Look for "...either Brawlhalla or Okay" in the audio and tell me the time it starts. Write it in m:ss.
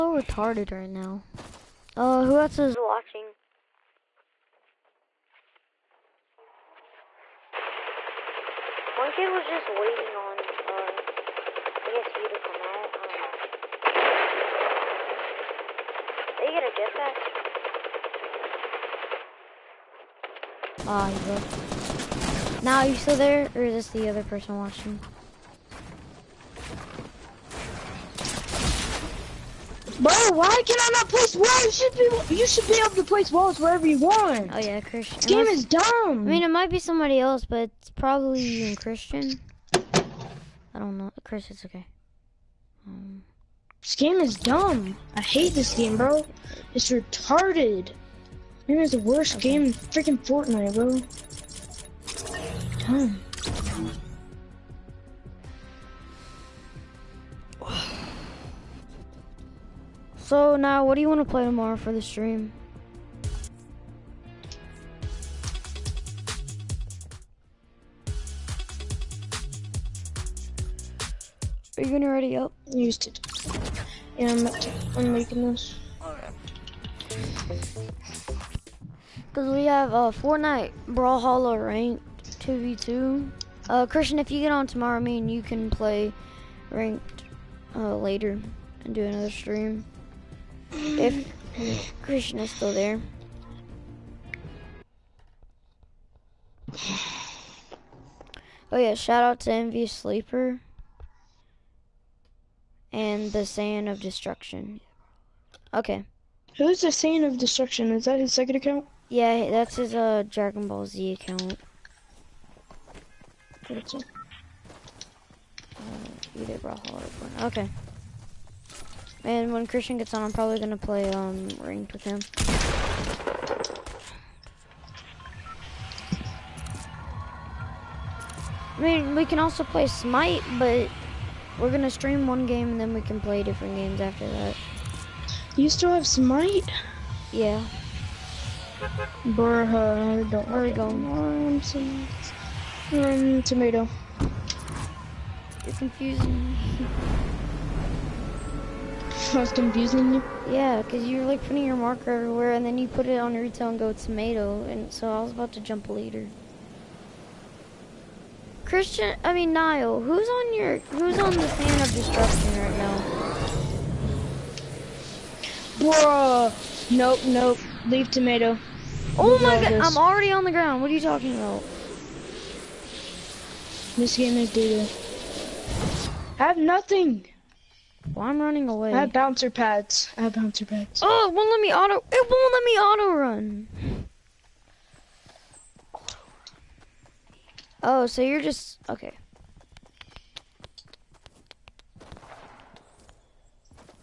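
1:56.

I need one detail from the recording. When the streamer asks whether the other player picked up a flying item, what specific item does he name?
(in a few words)
Jetpack.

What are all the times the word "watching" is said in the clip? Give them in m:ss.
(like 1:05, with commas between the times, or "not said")
0:02, 0:24.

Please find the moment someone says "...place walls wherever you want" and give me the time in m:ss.
0:33.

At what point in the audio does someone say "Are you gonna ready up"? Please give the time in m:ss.
1:11.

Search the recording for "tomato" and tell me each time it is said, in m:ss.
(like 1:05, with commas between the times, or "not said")
2:23, 2:33, 2:48.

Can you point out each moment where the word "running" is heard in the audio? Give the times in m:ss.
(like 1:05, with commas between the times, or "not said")
2:58.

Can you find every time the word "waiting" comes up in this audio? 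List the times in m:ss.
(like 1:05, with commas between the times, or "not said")
0:09.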